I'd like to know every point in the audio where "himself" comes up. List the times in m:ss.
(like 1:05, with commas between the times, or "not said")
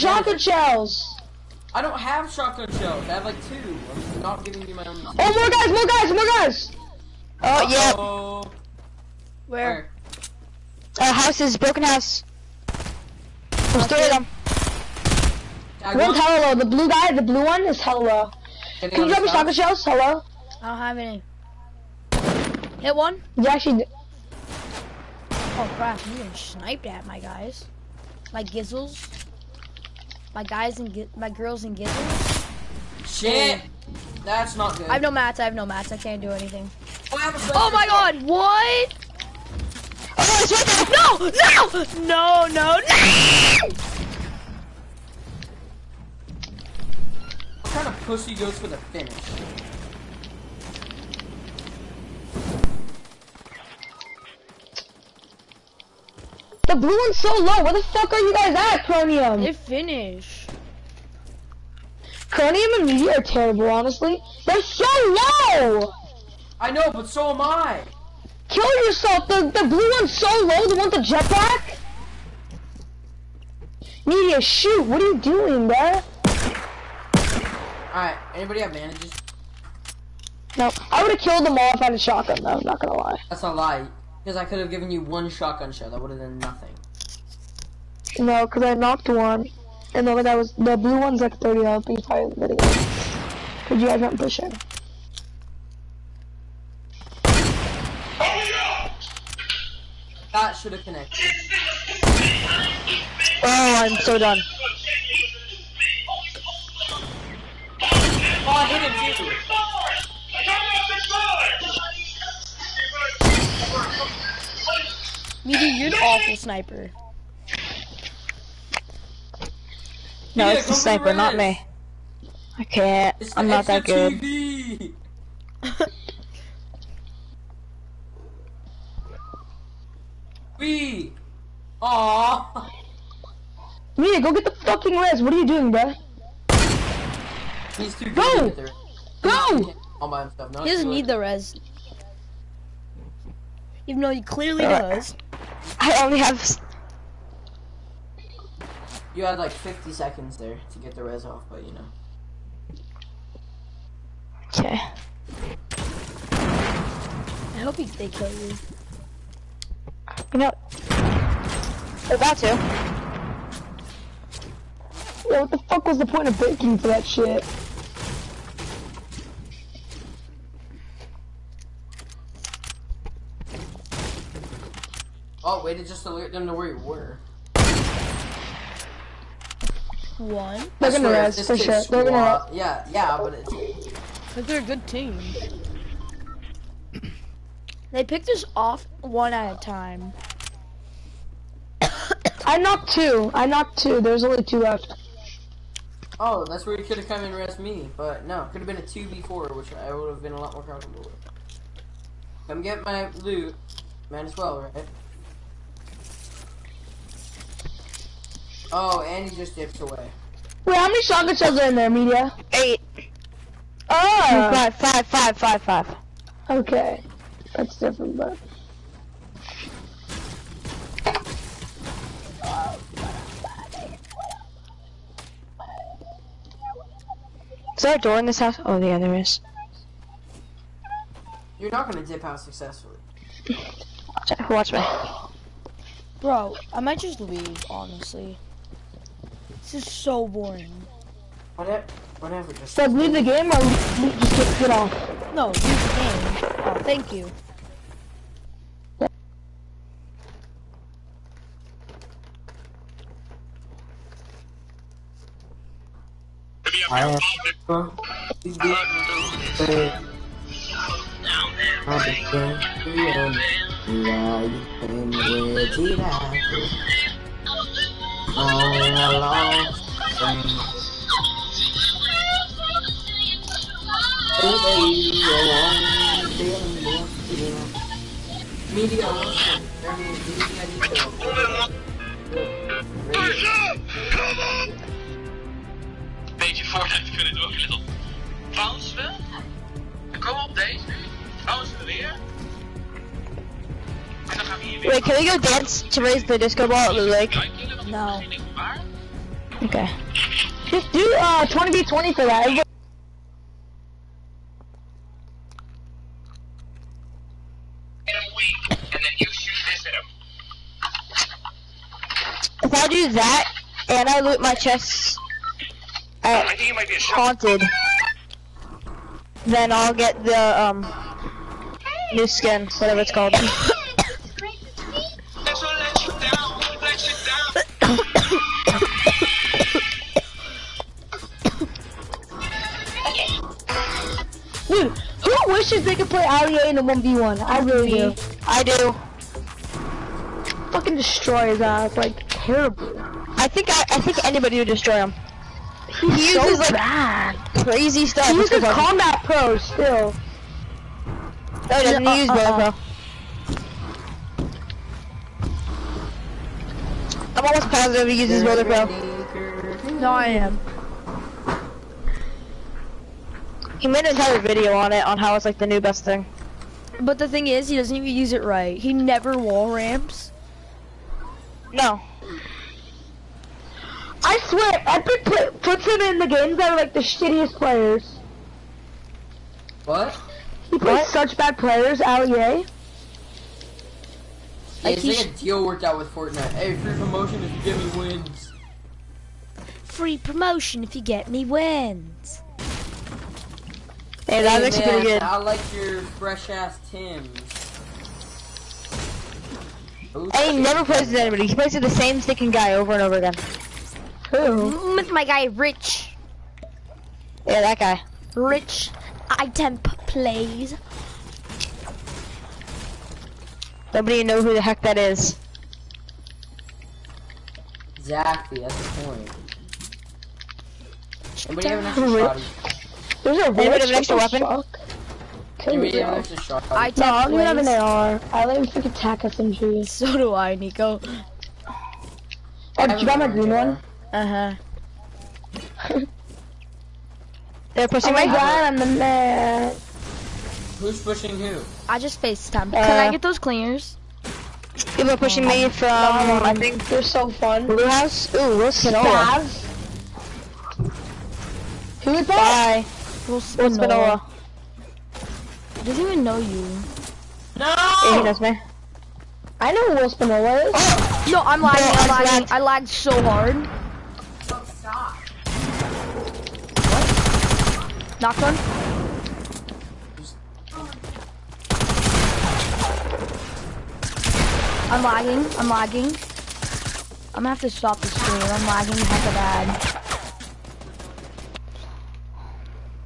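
2:20.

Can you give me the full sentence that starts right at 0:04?
Oh, more guys, more guys, more guys!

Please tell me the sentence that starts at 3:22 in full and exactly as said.
Come get my loot, might as well, right?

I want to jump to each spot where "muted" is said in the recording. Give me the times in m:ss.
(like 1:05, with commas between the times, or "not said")
not said.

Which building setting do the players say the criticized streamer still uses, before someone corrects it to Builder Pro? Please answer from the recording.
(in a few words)
Combat Pro.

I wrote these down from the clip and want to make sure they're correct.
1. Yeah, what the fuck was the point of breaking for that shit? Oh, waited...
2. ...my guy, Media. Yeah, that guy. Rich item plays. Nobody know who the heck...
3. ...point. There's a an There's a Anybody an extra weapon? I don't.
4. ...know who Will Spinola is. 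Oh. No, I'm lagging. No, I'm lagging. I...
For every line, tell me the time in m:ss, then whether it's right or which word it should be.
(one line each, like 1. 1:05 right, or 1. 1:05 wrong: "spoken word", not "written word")
1. 2:45 right
2. 6:45 wrong: "Rich", not "Media"
3. 6:59 right
4. 7:39 right.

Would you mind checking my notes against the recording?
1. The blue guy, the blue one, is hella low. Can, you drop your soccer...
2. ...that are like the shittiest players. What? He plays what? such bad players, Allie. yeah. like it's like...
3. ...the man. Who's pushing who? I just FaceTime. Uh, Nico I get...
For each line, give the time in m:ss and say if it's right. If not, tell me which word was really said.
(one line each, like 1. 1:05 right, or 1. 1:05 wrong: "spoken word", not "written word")
1. 0:16 right
2. 6:16 right
3. 7:18 wrong: "Can", not "Nico".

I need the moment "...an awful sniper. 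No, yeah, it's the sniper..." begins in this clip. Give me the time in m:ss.
1:55.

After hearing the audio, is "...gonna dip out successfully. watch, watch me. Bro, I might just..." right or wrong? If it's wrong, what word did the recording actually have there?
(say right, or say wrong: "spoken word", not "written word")
right.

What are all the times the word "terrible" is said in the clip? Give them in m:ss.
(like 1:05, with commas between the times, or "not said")
1:03, 5:42.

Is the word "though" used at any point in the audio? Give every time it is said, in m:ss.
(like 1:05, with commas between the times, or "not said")
1:22, 2:24.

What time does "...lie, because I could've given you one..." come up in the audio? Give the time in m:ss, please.
1:23.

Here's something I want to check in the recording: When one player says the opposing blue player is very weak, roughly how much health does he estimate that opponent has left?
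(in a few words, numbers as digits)
30.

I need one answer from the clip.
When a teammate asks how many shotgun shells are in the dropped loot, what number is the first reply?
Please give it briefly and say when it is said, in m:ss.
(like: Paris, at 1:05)
8, at 3:32.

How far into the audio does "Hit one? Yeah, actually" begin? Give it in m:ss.
0:22.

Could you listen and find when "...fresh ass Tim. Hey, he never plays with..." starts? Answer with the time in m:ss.
6:36.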